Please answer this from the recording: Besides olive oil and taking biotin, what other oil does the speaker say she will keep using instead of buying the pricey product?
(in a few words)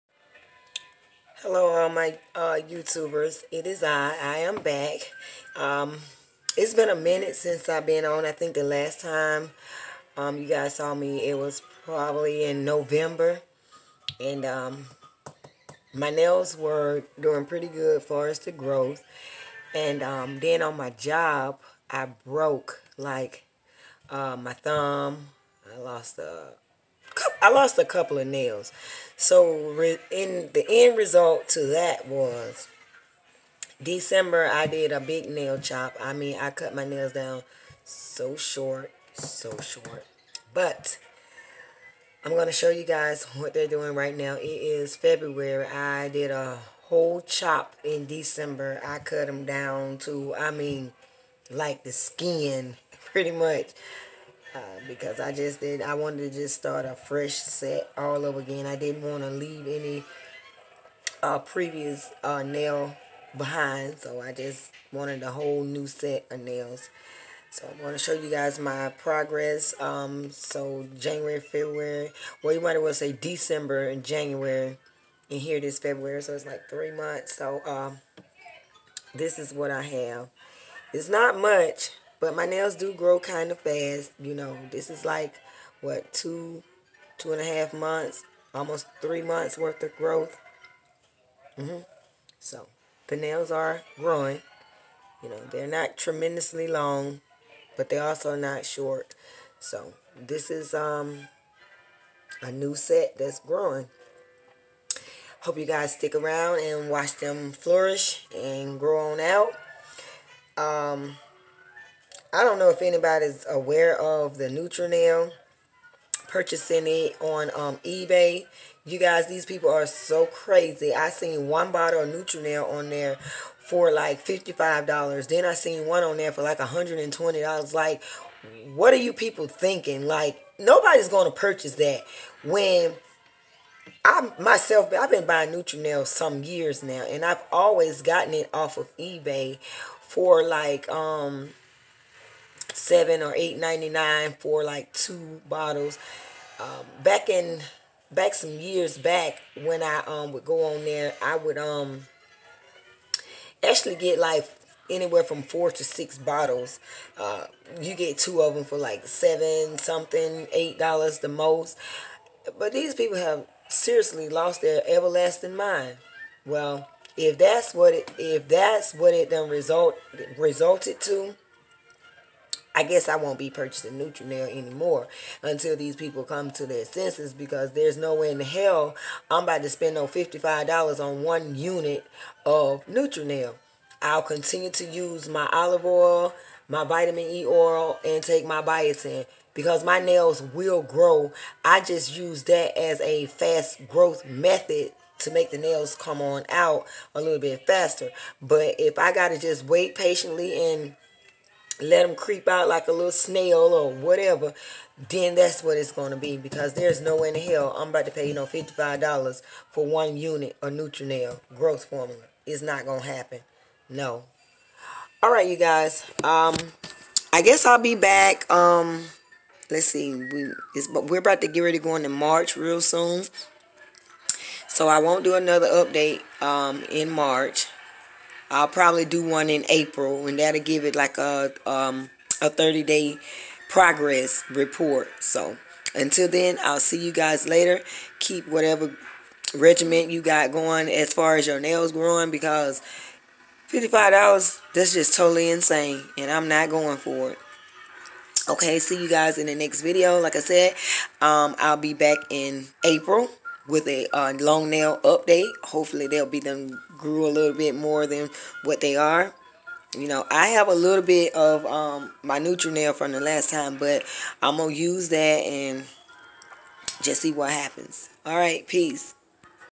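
Vitamin E oil.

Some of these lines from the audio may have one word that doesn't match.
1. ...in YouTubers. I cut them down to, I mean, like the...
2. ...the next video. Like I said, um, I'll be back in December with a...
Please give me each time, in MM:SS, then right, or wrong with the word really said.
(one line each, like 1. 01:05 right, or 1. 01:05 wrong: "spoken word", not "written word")
1. 00:47 wrong: "December", not "YouTubers"
2. 04:09 wrong: "April", not "December".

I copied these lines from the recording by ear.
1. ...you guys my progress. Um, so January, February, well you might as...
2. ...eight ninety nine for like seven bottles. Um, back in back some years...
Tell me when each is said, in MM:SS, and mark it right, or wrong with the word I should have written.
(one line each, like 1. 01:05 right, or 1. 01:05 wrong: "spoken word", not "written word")
1. 01:08 right
2. 02:23 wrong: "two", not "seven".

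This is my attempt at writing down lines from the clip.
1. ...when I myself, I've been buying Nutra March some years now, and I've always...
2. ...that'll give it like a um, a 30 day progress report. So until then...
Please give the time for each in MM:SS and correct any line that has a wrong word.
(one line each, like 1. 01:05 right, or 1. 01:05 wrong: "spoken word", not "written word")
1. 02:12 wrong: "Nail", not "March"
2. 03:50 right.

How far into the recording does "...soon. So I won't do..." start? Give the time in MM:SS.
03:42.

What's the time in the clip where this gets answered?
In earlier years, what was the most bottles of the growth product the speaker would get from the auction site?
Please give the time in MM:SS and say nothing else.
02:35.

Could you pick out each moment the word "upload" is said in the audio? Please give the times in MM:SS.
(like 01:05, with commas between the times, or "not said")
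not said.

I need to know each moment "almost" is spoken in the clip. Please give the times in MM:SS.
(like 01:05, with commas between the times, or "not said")
01:28.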